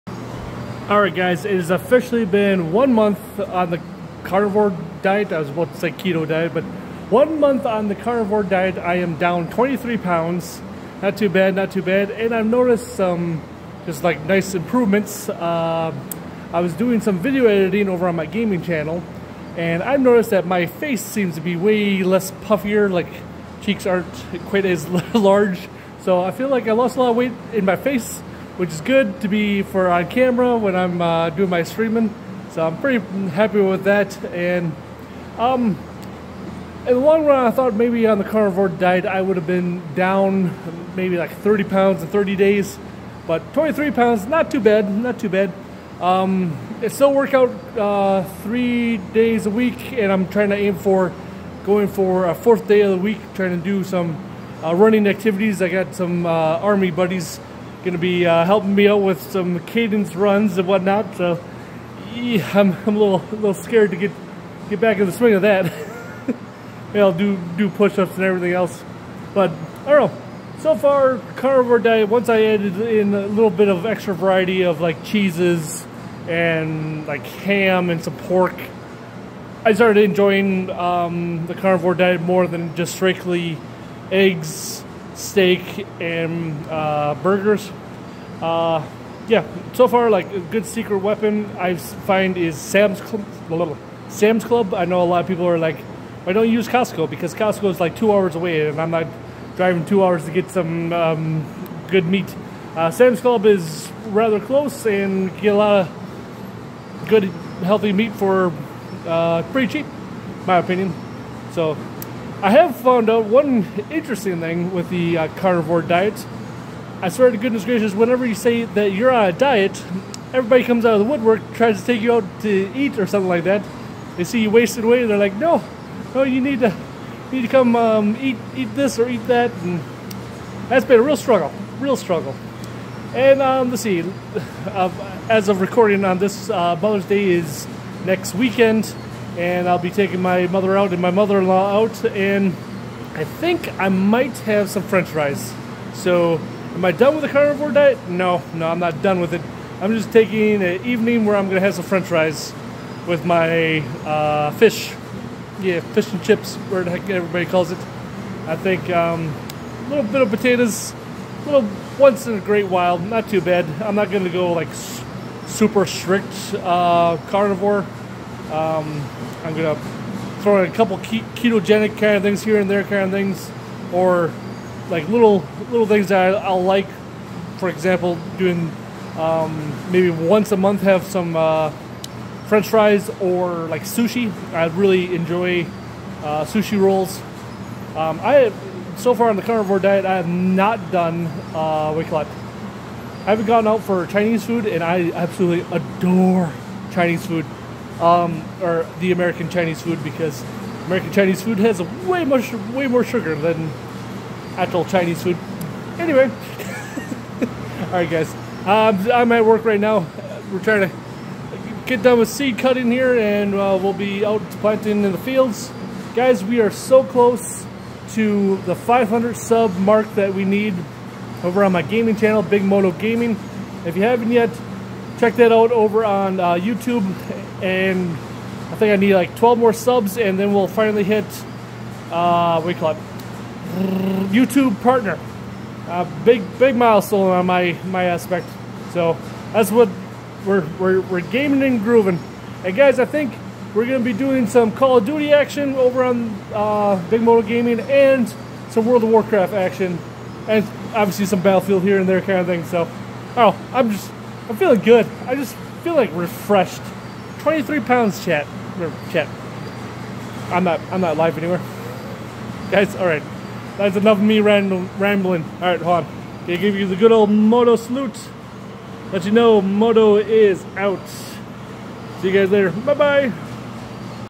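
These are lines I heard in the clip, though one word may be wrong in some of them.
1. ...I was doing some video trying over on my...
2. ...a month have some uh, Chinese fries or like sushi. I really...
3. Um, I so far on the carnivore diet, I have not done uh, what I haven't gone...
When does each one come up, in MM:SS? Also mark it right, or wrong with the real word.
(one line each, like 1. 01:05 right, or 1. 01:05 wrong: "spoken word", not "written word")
1. 00:16 wrong: "editing", not "trying"
2. 03:00 wrong: "French", not "Chinese"
3. 03:07 right.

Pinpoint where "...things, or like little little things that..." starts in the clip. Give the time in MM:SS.
02:53.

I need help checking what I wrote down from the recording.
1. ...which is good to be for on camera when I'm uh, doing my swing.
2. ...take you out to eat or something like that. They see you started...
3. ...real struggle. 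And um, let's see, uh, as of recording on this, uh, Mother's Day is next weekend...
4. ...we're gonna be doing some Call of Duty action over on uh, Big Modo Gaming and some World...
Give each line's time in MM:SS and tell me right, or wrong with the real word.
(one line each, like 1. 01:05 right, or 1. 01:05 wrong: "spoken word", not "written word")
1. 00:28 wrong: "streaming", not "swing"
2. 02:01 wrong: "wasted", not "started"
3. 02:11 right
4. 04:03 right.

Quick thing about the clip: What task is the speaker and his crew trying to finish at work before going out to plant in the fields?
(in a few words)
Seed cutting.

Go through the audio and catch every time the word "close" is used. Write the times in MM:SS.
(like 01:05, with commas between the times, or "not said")
01:44, 03:37.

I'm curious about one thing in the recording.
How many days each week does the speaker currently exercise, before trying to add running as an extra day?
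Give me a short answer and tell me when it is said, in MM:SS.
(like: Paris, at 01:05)
3 days, at 00:48.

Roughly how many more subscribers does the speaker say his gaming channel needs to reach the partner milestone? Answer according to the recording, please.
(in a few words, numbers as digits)
12.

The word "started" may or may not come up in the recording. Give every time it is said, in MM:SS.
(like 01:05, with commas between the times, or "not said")
01:19.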